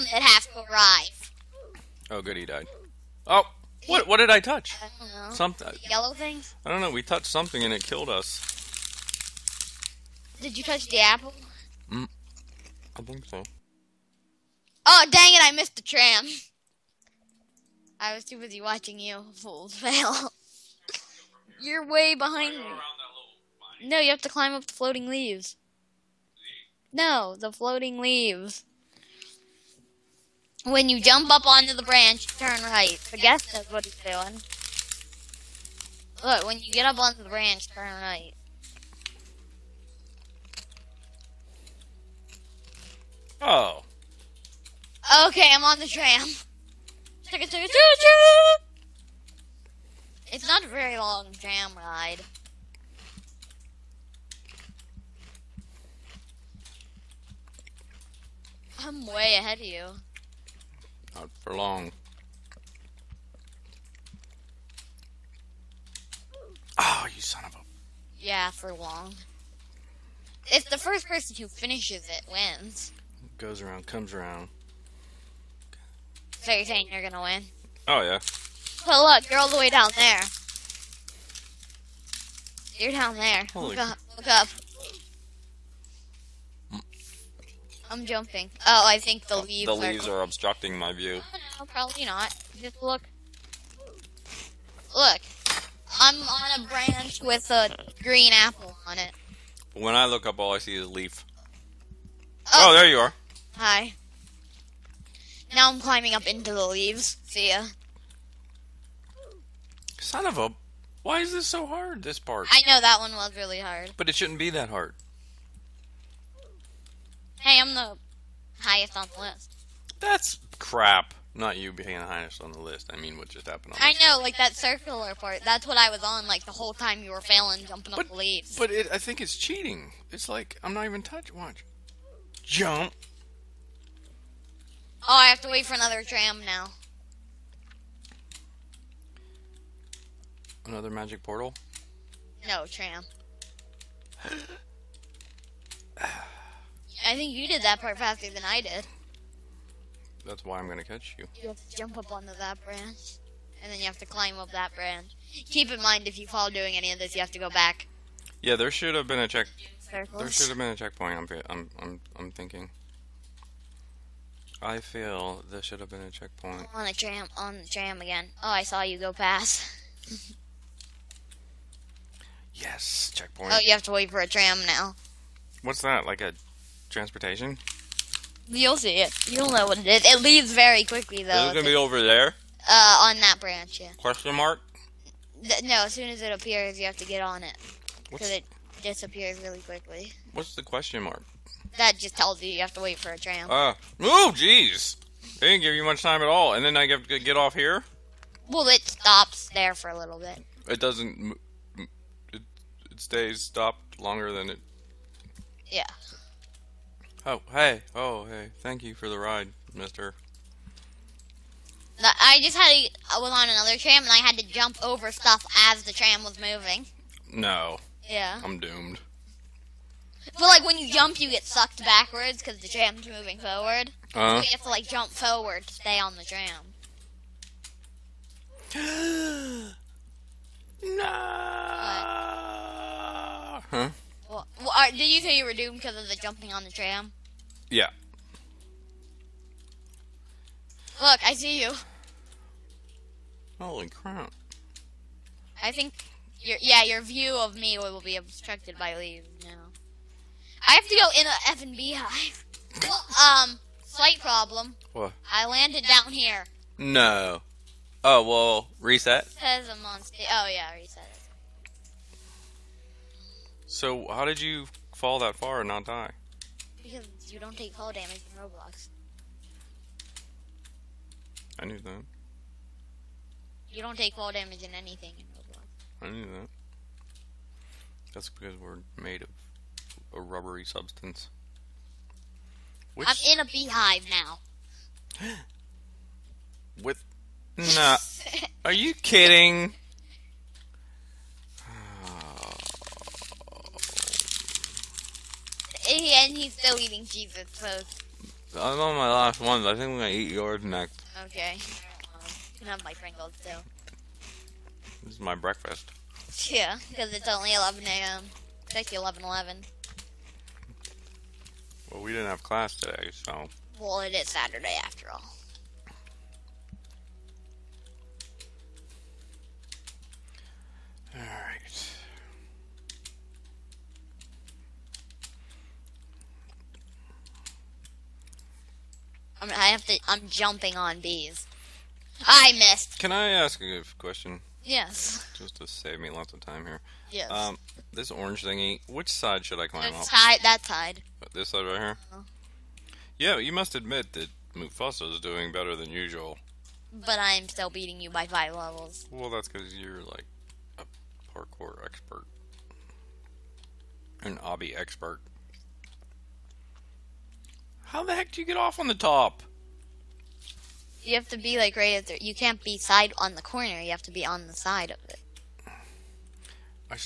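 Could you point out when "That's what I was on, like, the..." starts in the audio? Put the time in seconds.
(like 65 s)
125 s.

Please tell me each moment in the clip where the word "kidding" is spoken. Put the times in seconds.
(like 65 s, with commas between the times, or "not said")
288 s.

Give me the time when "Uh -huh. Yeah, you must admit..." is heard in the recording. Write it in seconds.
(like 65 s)
342 s.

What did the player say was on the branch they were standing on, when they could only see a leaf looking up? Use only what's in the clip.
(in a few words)
a green apple.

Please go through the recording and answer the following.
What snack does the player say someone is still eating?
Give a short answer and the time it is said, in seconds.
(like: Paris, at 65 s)
Cheez-Its, at 297 s.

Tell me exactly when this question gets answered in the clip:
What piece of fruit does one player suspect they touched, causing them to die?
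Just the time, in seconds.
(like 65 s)
10 s.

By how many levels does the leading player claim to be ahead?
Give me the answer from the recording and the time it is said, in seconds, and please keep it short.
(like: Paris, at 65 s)
5, at 348 s.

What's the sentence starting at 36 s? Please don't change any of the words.
Look, when you get up onto the branch, turn right.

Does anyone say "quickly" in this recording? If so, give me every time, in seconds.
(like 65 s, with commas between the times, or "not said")
180 s, 189 s.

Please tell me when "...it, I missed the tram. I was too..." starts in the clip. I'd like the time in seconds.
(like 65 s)
15 s.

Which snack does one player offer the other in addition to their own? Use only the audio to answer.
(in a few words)
Pringles.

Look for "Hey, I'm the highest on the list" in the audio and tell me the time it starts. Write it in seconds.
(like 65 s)
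117 s.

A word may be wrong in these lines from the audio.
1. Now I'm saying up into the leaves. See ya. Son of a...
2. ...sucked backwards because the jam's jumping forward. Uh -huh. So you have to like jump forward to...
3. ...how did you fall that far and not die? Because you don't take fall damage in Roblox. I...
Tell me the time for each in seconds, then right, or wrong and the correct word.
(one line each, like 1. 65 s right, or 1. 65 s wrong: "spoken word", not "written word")
1. 105 s wrong: "climbing", not "saying"
2. 221 s wrong: "moving", not "jumping"
3. 264 s right.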